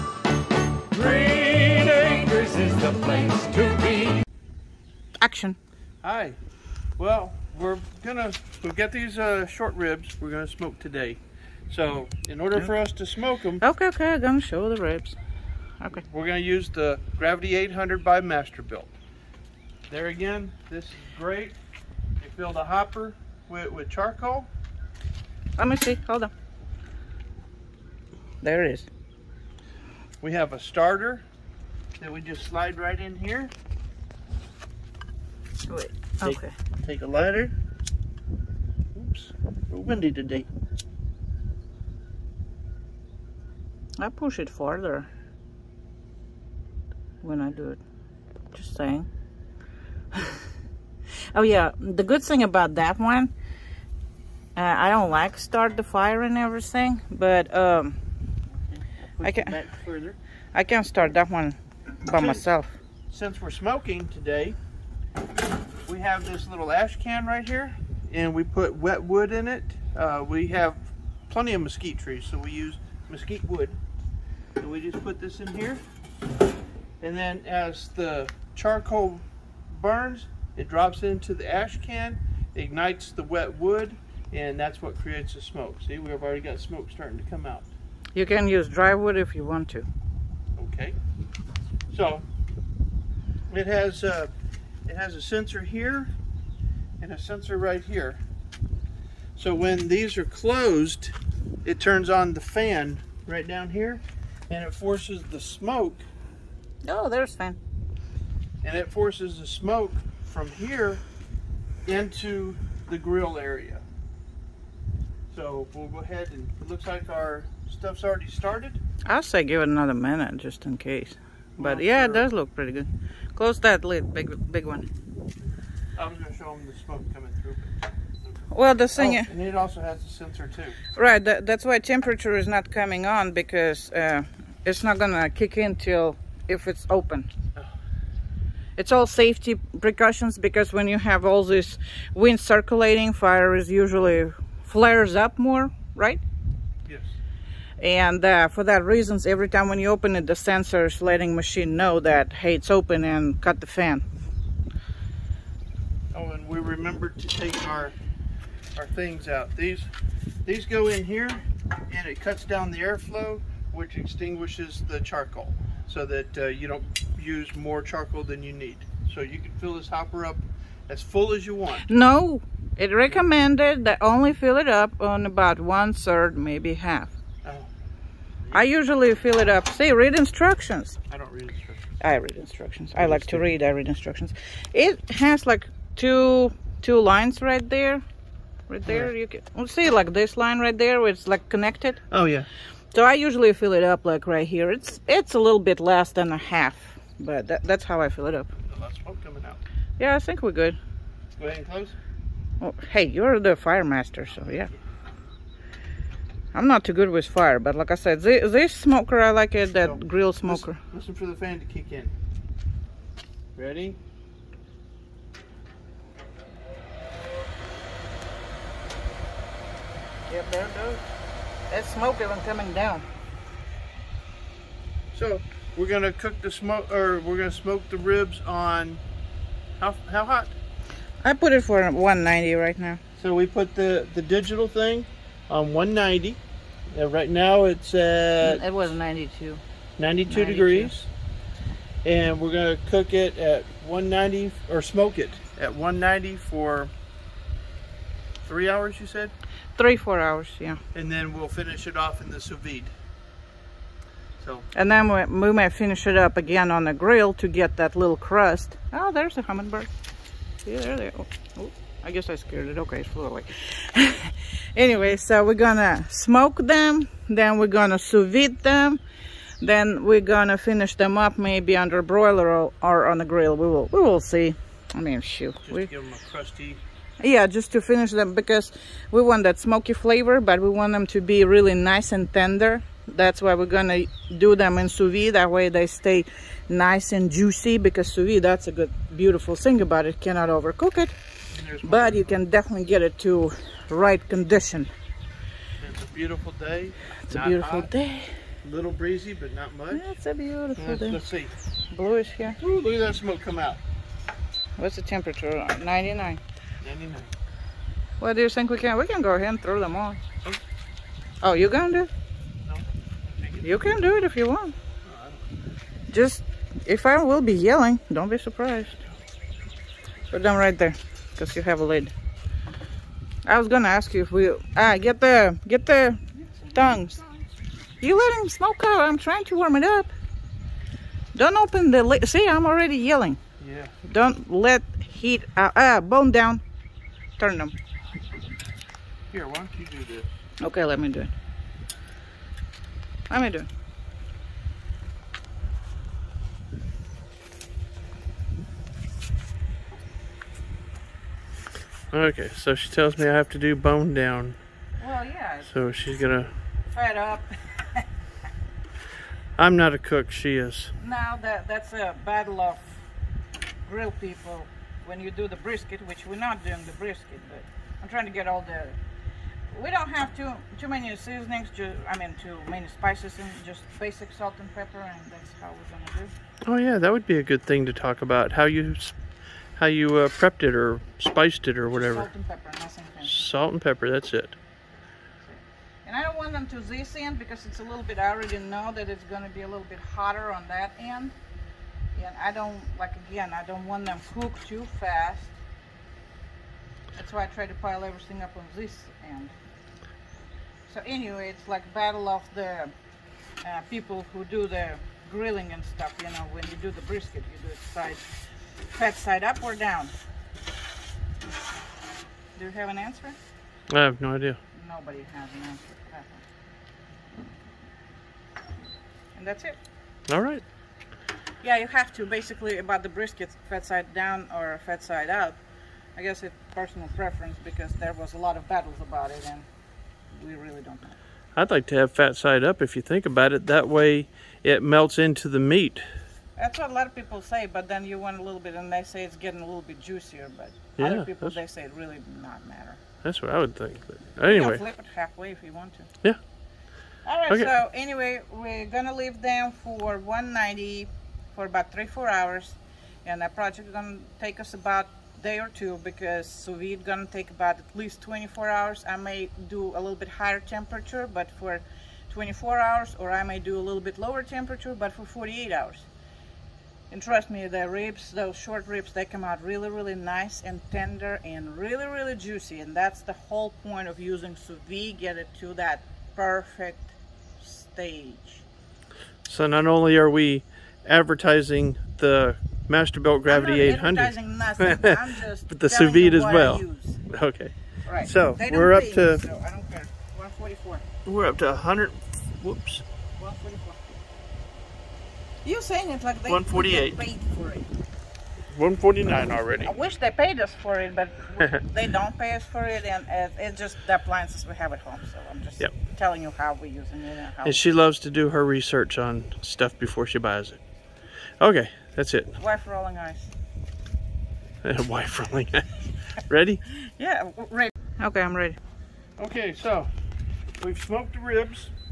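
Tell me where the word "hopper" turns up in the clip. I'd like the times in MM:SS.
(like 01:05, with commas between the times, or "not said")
00:22, 02:49.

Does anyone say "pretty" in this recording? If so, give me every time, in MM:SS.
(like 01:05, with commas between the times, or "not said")
02:02.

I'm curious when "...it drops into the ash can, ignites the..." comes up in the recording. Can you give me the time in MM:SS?
01:20.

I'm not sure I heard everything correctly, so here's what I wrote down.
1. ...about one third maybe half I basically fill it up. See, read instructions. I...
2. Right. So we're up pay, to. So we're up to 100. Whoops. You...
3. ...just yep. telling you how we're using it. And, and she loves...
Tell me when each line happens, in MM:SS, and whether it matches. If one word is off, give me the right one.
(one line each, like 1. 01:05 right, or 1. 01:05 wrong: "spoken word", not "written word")
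1. 02:55 wrong: "usually", not "basically"
2. 08:08 right
3. 08:25 right.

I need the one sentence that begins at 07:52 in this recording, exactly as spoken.
And that's the whole point of using sous vide, get it to that perfect stage.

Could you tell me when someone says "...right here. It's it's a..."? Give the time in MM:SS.
03:14.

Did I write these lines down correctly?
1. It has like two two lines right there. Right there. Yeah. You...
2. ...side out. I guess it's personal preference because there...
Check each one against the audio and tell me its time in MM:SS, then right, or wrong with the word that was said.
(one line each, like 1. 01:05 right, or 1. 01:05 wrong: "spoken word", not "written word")
1. 03:04 right
2. 07:05 right.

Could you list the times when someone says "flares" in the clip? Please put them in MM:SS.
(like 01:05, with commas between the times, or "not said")
02:24.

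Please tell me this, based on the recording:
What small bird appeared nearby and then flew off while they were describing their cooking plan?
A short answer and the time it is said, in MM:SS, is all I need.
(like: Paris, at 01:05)
hummingbird, at 04:19.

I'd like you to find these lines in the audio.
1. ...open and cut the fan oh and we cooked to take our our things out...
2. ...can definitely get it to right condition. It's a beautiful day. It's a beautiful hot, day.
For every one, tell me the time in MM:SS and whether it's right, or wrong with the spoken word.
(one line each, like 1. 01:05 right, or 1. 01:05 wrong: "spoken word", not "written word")
1. 02:32 wrong: "remembered", not "cooked"
2. 04:52 right.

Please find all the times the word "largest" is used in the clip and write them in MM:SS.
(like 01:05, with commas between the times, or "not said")
not said.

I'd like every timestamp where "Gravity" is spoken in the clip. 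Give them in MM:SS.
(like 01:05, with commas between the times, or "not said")
00:17, 08:03.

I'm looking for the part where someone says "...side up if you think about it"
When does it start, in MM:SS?
07:12.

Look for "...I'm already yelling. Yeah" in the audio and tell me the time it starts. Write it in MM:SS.
05:32.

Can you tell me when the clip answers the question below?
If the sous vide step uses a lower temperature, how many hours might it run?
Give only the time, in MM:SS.
07:45.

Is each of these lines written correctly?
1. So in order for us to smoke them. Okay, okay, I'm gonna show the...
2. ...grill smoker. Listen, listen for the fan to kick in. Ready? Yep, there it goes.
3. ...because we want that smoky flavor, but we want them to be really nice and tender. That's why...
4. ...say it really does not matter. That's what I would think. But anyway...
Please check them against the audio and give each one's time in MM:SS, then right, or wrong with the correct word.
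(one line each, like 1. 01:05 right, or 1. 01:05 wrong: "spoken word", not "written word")
1. 00:11 right
2. 03:29 right
3. 04:38 right
4. 07:21 right.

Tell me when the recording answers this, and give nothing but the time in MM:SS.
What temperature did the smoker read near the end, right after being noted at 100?
08:18.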